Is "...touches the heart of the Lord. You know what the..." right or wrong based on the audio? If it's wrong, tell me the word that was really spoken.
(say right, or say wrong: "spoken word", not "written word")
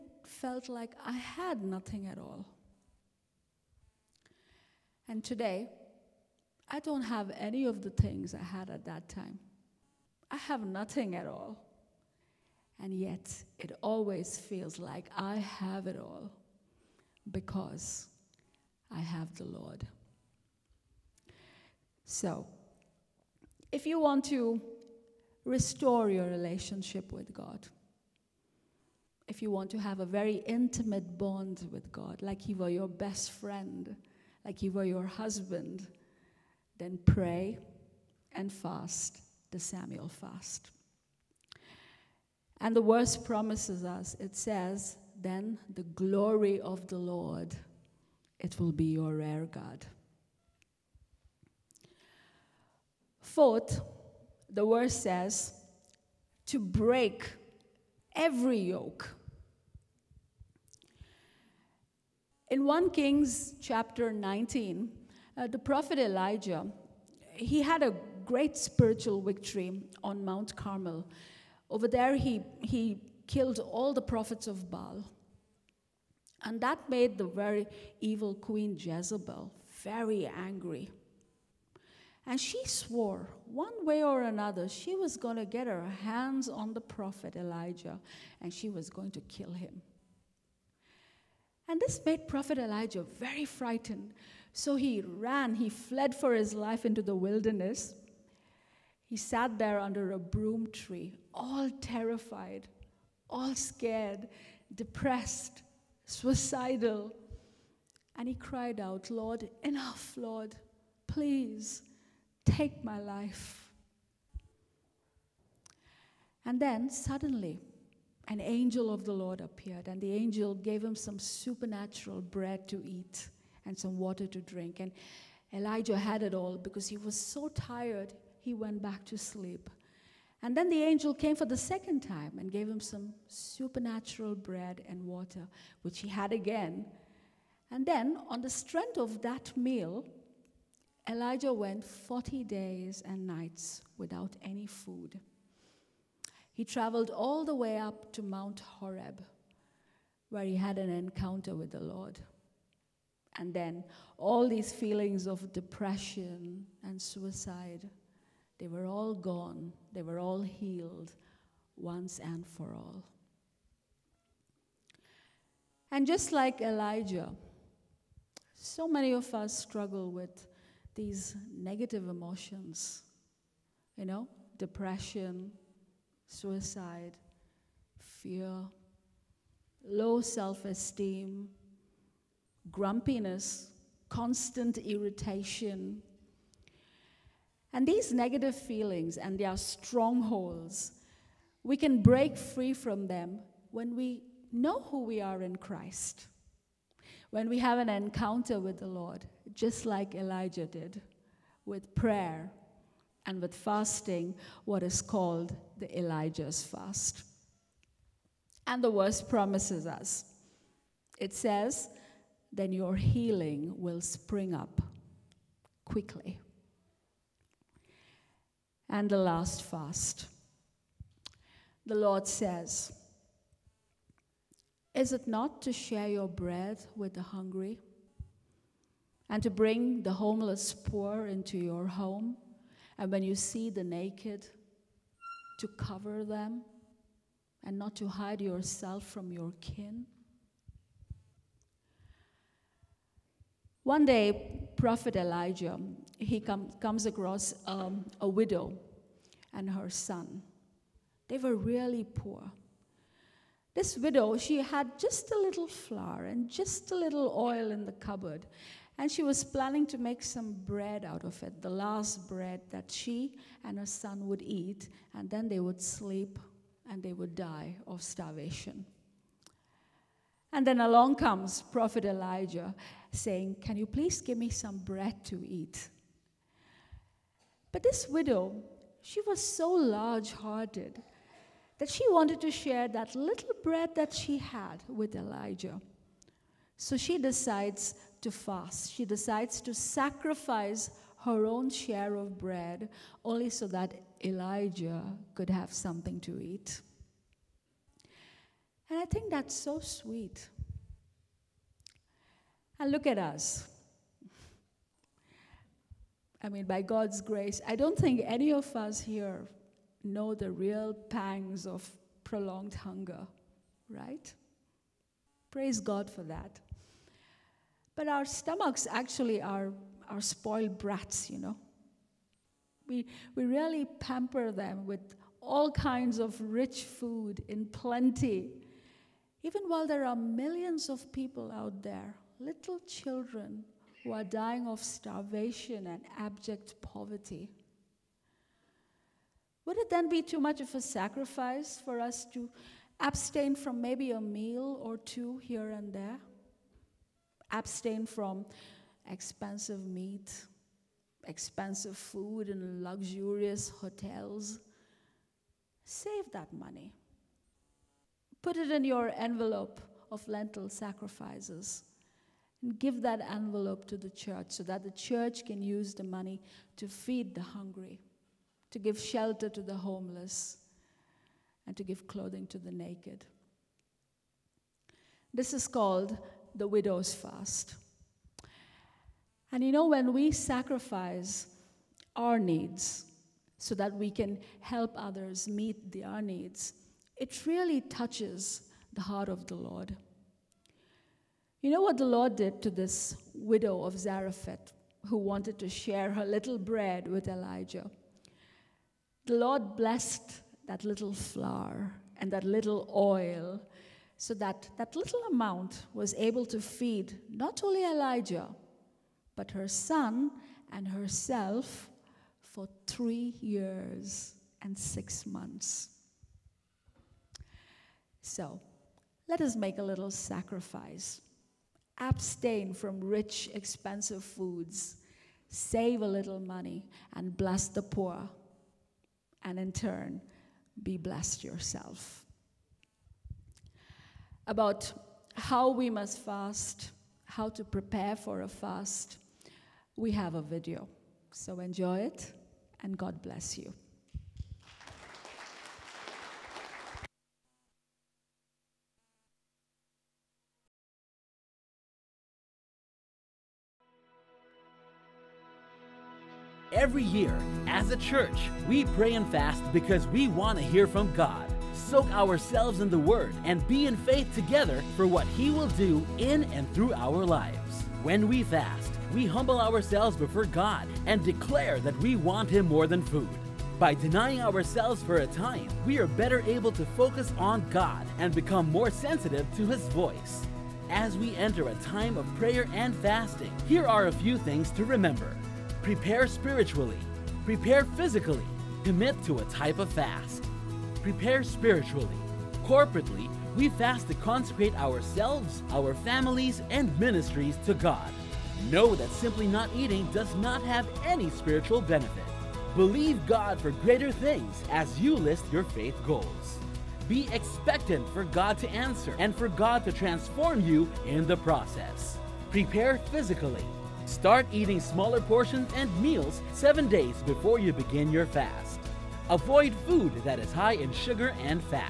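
right.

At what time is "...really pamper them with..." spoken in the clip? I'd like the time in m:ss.
5:23.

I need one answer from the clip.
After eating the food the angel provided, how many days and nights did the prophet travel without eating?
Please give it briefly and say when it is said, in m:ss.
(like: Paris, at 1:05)
40, at 2:21.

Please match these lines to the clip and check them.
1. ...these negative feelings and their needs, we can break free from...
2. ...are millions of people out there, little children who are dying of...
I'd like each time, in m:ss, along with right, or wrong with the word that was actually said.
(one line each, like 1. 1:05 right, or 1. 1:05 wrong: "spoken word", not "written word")
1. 3:07 wrong: "strongholds", not "needs"
2. 5:30 right.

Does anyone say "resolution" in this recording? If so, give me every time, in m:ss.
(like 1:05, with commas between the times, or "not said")
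not said.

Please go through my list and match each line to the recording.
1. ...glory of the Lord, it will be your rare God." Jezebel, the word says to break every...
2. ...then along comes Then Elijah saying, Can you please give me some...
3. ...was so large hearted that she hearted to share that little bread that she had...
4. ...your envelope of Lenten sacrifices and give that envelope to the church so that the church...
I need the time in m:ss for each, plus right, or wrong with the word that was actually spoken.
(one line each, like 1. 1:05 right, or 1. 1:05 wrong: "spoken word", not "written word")
1. 0:45 wrong: "Fourth", not "Jezebel"
2. 4:30 wrong: "Prophet", not "Then"
3. 4:39 wrong: "wanted", not "hearted"
4. 5:58 right.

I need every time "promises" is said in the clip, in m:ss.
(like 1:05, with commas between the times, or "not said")
0:43, 3:29.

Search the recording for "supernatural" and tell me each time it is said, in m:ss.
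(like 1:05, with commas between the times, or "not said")
2:01, 2:13.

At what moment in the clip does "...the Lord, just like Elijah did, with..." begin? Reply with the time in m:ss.
3:18.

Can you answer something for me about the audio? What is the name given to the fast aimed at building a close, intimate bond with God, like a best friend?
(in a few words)
Samuel fast.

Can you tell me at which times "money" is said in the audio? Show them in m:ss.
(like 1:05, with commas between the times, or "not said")
5:56, 6:06, 7:06.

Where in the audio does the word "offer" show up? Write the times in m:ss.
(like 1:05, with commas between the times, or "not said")
not said.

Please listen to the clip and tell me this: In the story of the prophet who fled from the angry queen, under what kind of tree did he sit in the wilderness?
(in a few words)
broom tree.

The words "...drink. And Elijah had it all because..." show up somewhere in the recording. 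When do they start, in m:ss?
2:04.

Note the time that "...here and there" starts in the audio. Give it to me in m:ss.
5:45.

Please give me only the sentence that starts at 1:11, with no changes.
Over there, he, he killed all the prophets of Baal.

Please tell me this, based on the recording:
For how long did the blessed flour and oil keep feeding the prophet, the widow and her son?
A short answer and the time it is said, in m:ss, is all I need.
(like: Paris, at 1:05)
3 years and 6 months, at 6:52.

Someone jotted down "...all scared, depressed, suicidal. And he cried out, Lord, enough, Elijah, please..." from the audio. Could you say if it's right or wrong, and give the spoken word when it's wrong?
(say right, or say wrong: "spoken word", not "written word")
wrong: "Lord", not "Elijah".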